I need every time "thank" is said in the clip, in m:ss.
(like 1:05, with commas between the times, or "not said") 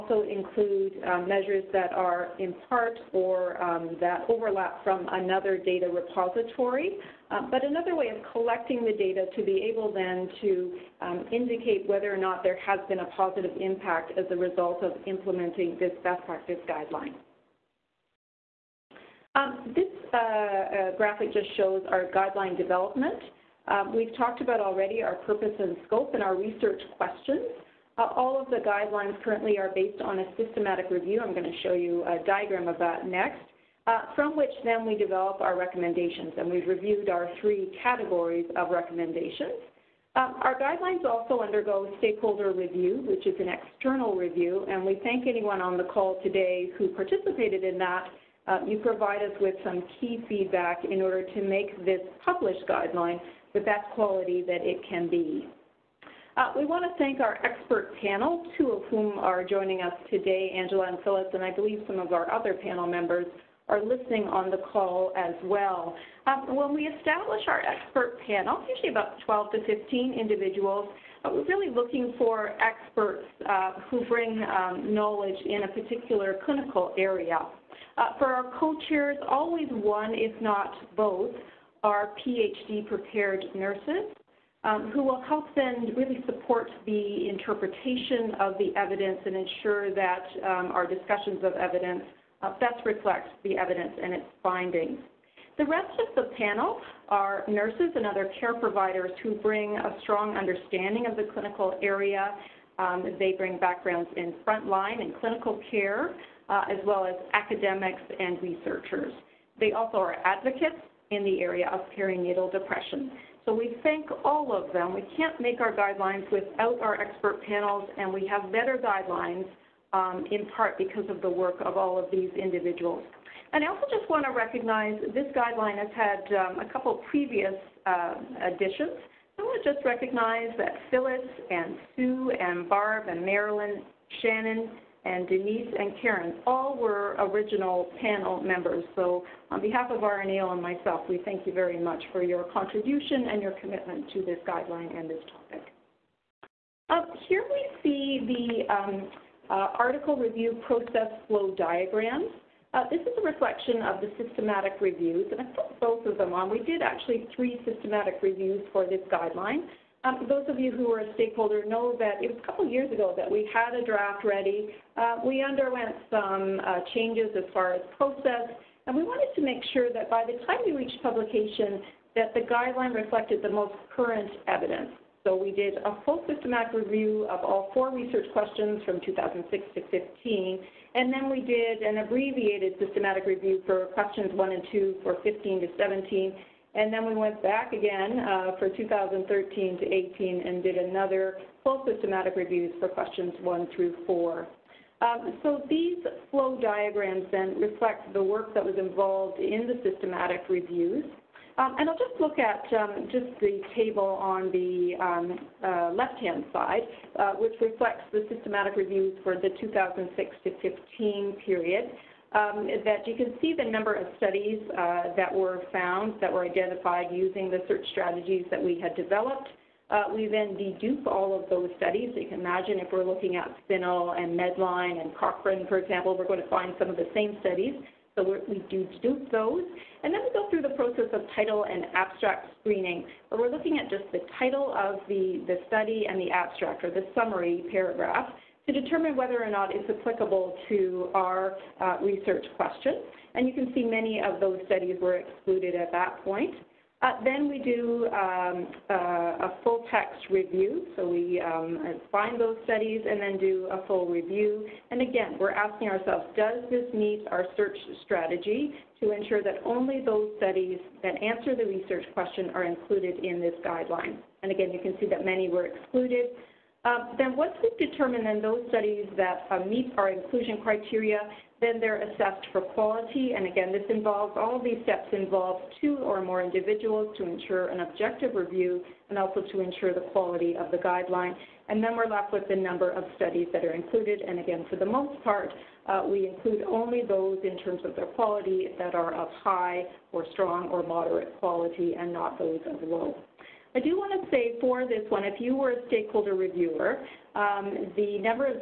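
0:45, 0:57, 1:53, 2:21.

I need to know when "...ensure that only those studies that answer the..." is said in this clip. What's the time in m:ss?
4:19.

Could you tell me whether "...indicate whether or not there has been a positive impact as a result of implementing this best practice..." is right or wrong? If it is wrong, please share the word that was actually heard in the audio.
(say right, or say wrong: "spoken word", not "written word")
right.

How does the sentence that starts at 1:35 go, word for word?
The rest of the panel are nurses and other care providers who bring a strong understanding of the clinical area.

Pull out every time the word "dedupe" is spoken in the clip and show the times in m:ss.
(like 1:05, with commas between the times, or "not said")
3:40, 3:49.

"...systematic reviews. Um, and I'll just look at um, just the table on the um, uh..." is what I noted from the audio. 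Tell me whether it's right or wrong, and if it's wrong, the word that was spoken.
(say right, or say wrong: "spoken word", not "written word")
right.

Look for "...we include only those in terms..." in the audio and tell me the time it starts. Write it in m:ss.
4:46.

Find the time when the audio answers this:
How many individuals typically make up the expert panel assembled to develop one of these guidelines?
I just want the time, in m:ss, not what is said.
1:09.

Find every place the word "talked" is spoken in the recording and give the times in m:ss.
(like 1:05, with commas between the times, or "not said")
0:24.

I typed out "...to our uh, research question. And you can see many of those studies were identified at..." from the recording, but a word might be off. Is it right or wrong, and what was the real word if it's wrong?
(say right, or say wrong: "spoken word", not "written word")
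wrong: "excluded", not "identified".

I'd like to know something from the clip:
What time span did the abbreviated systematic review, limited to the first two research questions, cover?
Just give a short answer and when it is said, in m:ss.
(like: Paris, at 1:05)
2015 to 2017, at 3:05.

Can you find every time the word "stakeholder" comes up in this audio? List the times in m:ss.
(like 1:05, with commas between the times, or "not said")
0:41, 2:41, 4:55.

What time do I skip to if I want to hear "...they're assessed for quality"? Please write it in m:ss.
4:31.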